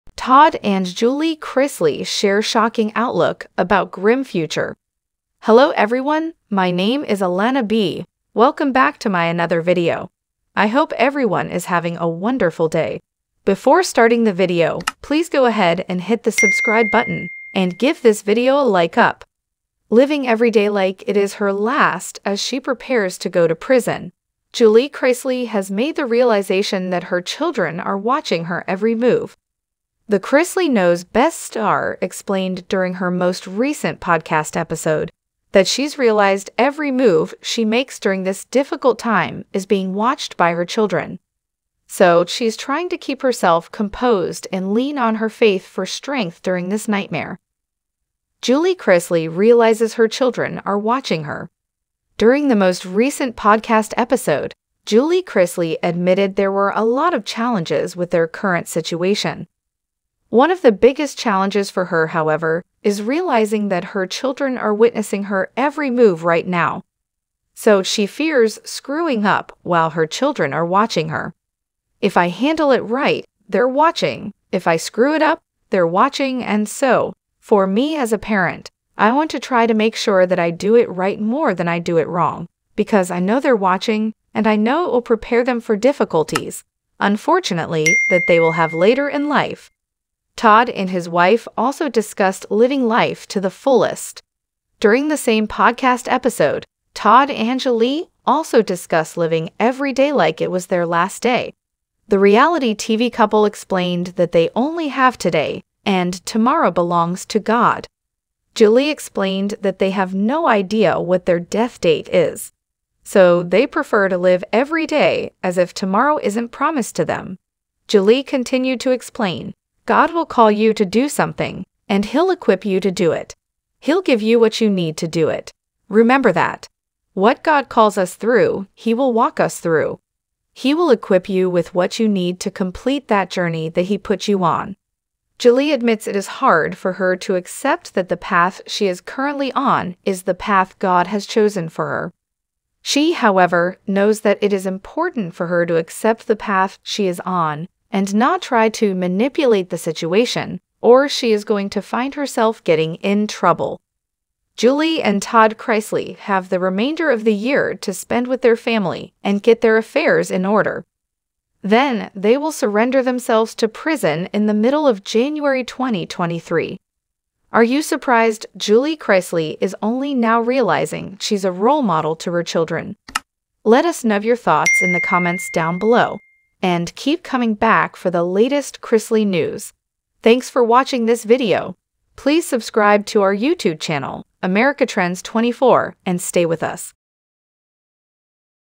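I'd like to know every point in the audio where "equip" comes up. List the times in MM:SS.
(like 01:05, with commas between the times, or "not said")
02:02, 02:10.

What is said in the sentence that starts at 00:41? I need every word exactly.
So she's trying to keep herself composed and lean on her faith for strength during this nightmare.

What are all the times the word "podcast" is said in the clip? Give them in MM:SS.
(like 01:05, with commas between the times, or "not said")
00:34, 00:53, 01:35.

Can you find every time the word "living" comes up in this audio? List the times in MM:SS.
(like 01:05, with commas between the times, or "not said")
00:19, 01:32, 01:39.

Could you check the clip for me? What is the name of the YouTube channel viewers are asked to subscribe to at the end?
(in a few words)
America Trends 24.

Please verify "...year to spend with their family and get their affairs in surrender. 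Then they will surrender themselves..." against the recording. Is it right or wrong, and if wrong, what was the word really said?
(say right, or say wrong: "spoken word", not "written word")
wrong: "order", not "surrender".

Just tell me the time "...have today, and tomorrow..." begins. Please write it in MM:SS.
01:44.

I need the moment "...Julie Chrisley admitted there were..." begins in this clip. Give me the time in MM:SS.
00:54.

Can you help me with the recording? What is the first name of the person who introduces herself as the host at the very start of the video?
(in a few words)
Alana.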